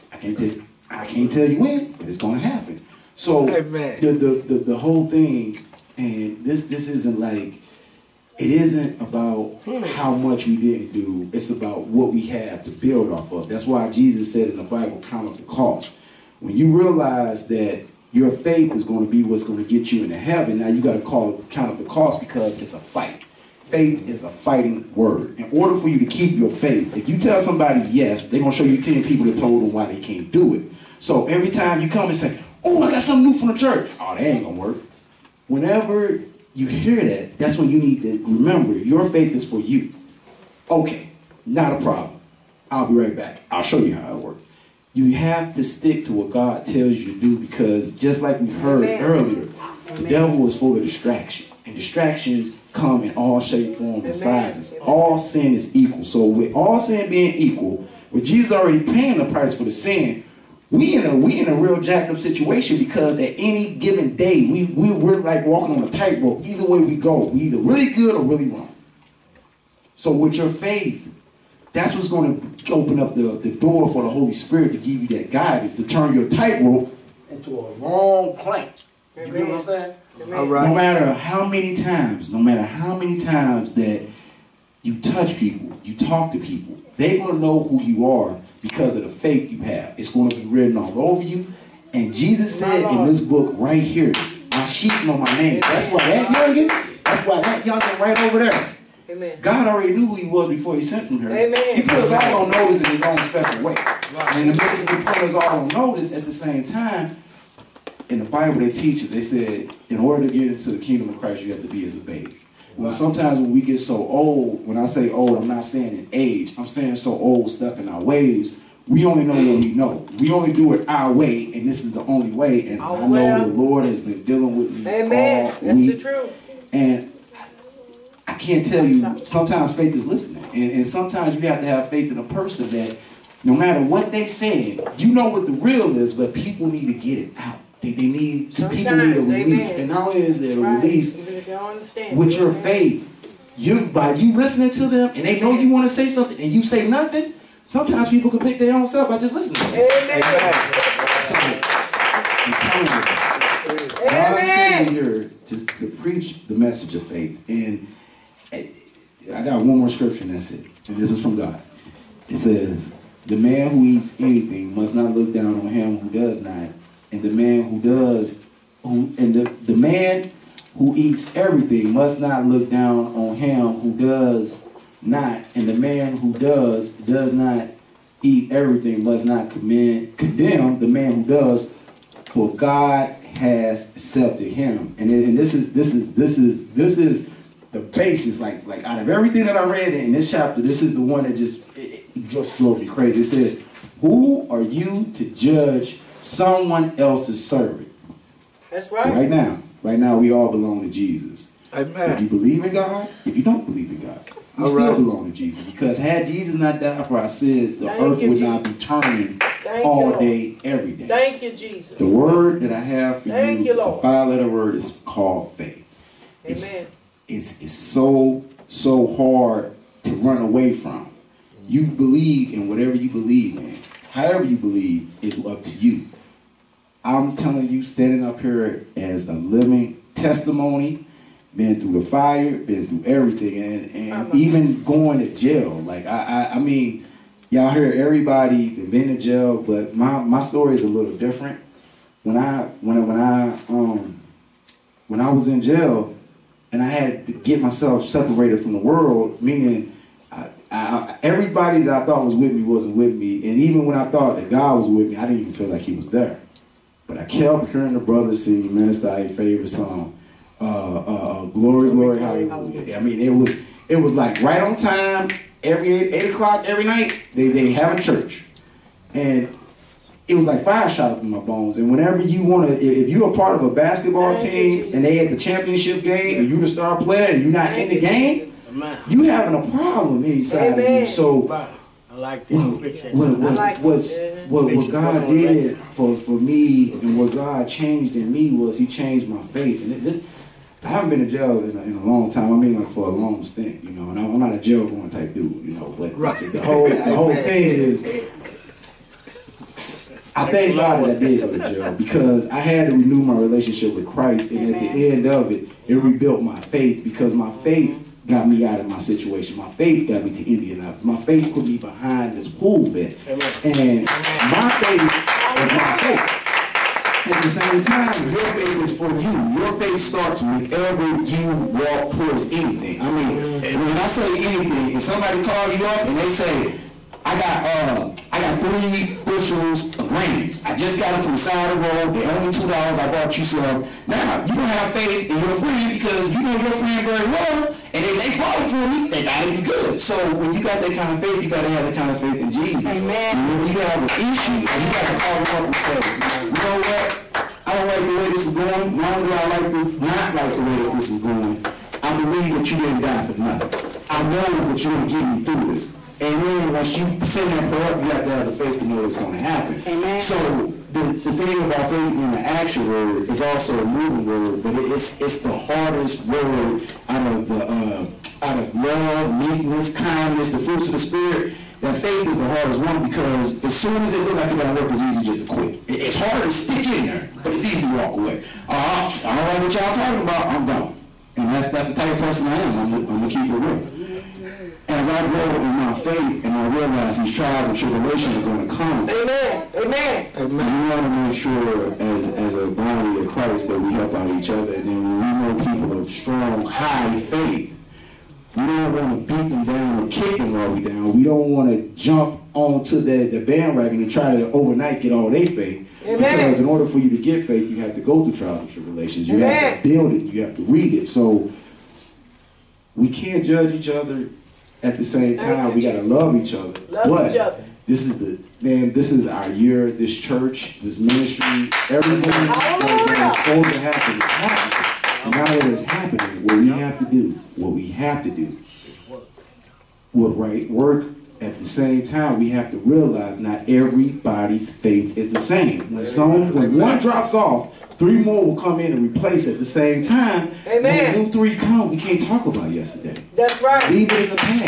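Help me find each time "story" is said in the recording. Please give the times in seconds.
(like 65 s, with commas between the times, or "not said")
240 s.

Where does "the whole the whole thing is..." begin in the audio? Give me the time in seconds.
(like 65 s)
296 s.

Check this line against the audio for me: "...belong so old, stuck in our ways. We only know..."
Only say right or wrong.
wrong.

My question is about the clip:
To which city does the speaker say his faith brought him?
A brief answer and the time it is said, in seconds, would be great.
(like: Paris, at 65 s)
Indianapolis, at 310 s.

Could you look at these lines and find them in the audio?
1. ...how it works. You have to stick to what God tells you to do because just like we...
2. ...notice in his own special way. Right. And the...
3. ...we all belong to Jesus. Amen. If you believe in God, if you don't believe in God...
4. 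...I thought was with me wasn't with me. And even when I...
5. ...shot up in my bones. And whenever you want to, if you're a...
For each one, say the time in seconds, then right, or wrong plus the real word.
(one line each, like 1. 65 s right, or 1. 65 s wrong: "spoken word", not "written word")
1. 43 s right
2. 102 s right
3. 200 s right
4. 252 s right
5. 270 s right.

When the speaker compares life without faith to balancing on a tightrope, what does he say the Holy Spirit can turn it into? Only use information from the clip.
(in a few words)
a long plank.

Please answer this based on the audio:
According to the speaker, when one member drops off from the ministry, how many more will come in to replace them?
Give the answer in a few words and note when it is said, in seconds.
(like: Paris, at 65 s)
3, at 437 s.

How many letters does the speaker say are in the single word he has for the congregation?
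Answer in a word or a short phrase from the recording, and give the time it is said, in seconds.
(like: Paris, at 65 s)
5, at 214 s.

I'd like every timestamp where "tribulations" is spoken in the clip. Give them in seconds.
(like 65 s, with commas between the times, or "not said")
387 s, 408 s.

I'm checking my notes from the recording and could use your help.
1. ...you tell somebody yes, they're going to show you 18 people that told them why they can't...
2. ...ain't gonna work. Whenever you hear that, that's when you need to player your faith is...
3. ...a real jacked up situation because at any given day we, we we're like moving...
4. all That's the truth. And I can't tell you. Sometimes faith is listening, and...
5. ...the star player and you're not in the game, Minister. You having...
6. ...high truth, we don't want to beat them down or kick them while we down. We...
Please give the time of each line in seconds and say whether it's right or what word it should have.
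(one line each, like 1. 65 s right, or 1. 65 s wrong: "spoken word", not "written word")
1. 27 s wrong: "10", not "18"
2. 34 s wrong: "remember", not "player"
3. 61 s wrong: "walking", not "moving"
4. 125 s right
5. 276 s wrong: "Amen", not "Minister"
6. 396 s wrong: "faith", not "truth".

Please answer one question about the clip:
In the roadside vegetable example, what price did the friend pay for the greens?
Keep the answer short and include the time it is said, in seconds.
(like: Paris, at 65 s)
2 dollars, at 332 s.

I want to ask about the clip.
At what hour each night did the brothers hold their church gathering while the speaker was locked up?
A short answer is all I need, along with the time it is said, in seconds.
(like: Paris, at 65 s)
8 o'clock, at 266 s.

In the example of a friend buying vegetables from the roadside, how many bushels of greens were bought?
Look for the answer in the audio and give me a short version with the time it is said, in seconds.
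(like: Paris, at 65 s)
3, at 328 s.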